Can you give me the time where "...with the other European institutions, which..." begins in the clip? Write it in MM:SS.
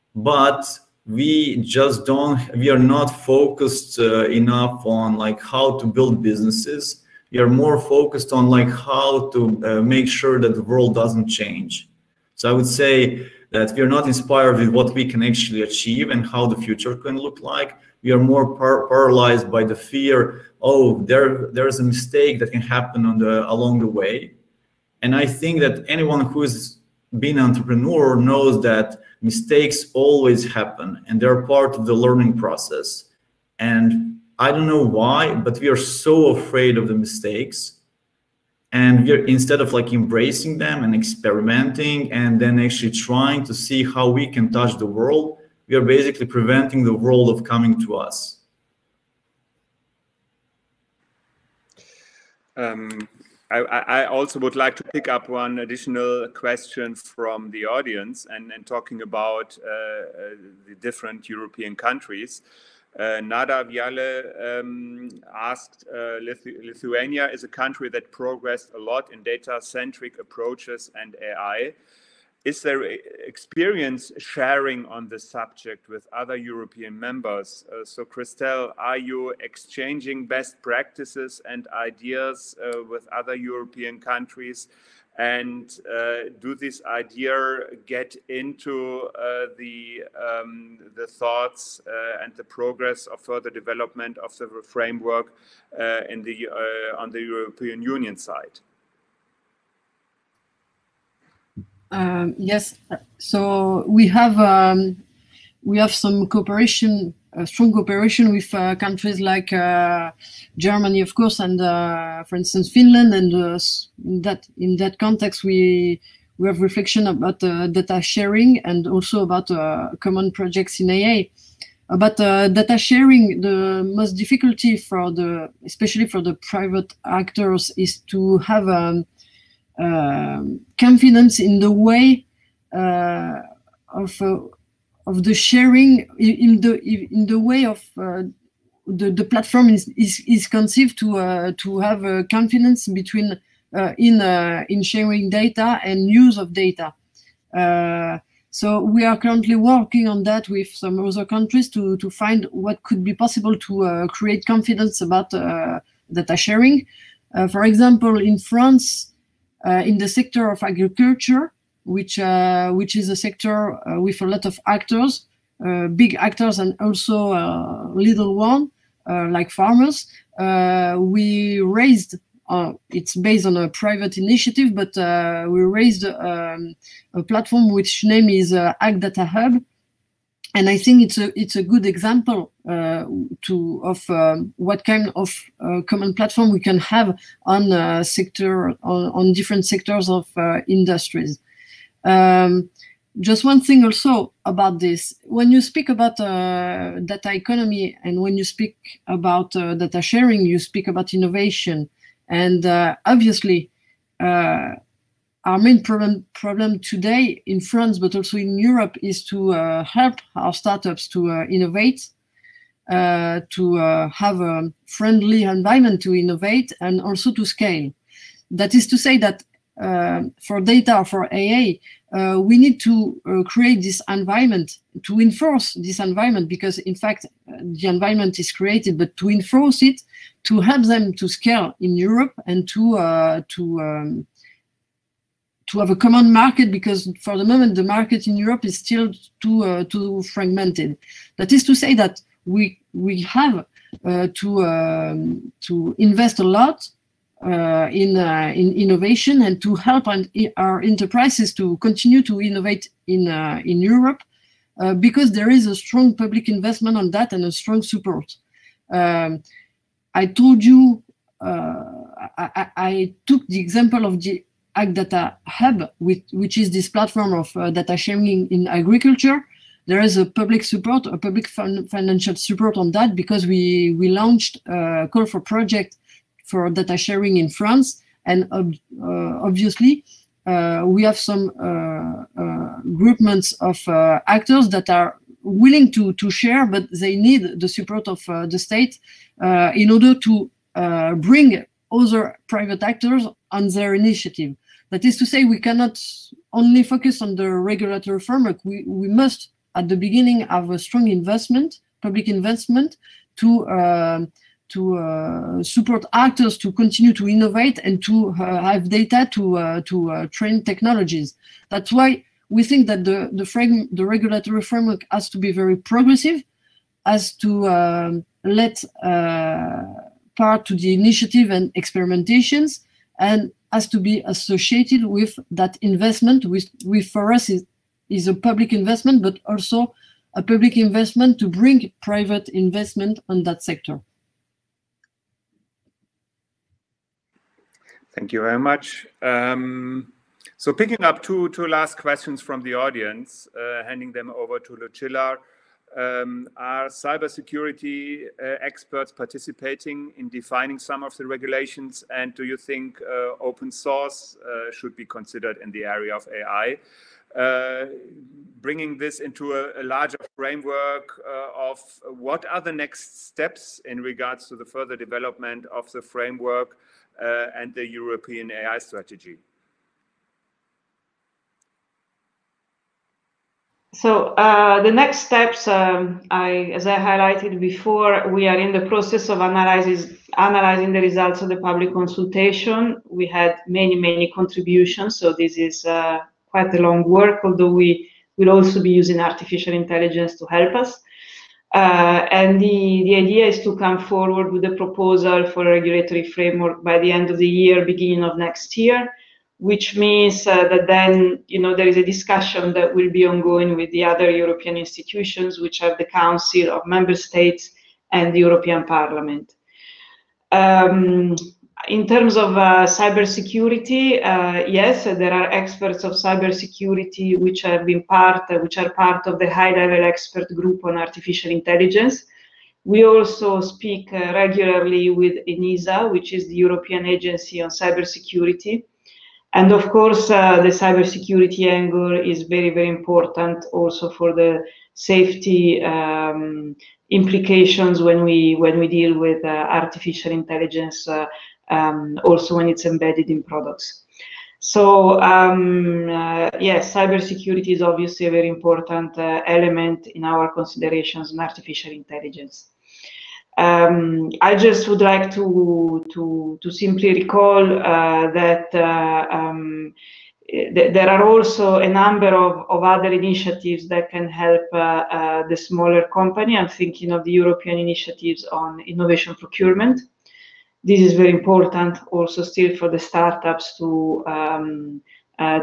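06:43.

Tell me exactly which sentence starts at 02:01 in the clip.
But data sharing, the most difficulty for the especially for the private actors is to have.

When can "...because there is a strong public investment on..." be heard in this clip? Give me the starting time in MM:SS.
04:14.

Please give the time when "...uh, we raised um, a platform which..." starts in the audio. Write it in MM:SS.
02:54.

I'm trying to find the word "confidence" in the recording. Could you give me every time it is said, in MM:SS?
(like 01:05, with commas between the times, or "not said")
02:10, 02:22, 02:34.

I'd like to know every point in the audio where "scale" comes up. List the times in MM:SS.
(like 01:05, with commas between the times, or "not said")
03:37, 03:51.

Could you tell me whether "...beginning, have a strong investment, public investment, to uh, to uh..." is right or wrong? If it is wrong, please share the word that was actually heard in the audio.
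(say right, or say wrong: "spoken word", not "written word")
right.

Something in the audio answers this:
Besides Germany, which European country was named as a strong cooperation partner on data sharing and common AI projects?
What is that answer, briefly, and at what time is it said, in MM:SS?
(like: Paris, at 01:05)
Finland, at 01:52.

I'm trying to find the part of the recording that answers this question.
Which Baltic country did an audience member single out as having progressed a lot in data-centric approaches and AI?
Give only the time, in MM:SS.
01:06.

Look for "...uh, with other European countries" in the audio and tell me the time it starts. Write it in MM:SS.
01:22.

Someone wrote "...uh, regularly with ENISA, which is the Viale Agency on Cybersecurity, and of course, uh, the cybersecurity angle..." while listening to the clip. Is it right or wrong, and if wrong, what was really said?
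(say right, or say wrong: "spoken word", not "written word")
wrong: "European", not "Viale".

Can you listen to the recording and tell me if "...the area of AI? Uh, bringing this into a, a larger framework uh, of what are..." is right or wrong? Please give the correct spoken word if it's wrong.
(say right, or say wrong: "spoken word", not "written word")
right.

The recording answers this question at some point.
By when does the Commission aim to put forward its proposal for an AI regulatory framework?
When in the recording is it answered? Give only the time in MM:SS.
06:36.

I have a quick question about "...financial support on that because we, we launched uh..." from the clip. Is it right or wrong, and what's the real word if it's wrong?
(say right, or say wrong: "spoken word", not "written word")
right.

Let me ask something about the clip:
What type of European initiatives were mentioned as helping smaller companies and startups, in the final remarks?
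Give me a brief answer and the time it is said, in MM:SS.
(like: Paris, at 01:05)
Innovation procurement, at 07:48.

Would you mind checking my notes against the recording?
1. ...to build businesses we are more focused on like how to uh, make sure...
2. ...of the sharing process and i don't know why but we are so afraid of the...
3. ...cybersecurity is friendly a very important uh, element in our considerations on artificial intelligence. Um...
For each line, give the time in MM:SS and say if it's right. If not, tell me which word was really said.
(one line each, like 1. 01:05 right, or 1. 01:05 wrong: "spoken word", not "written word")
1. 00:05 right
2. 00:31 wrong: "learning", not "sharing"
3. 07:26 wrong: "obviously", not "friendly".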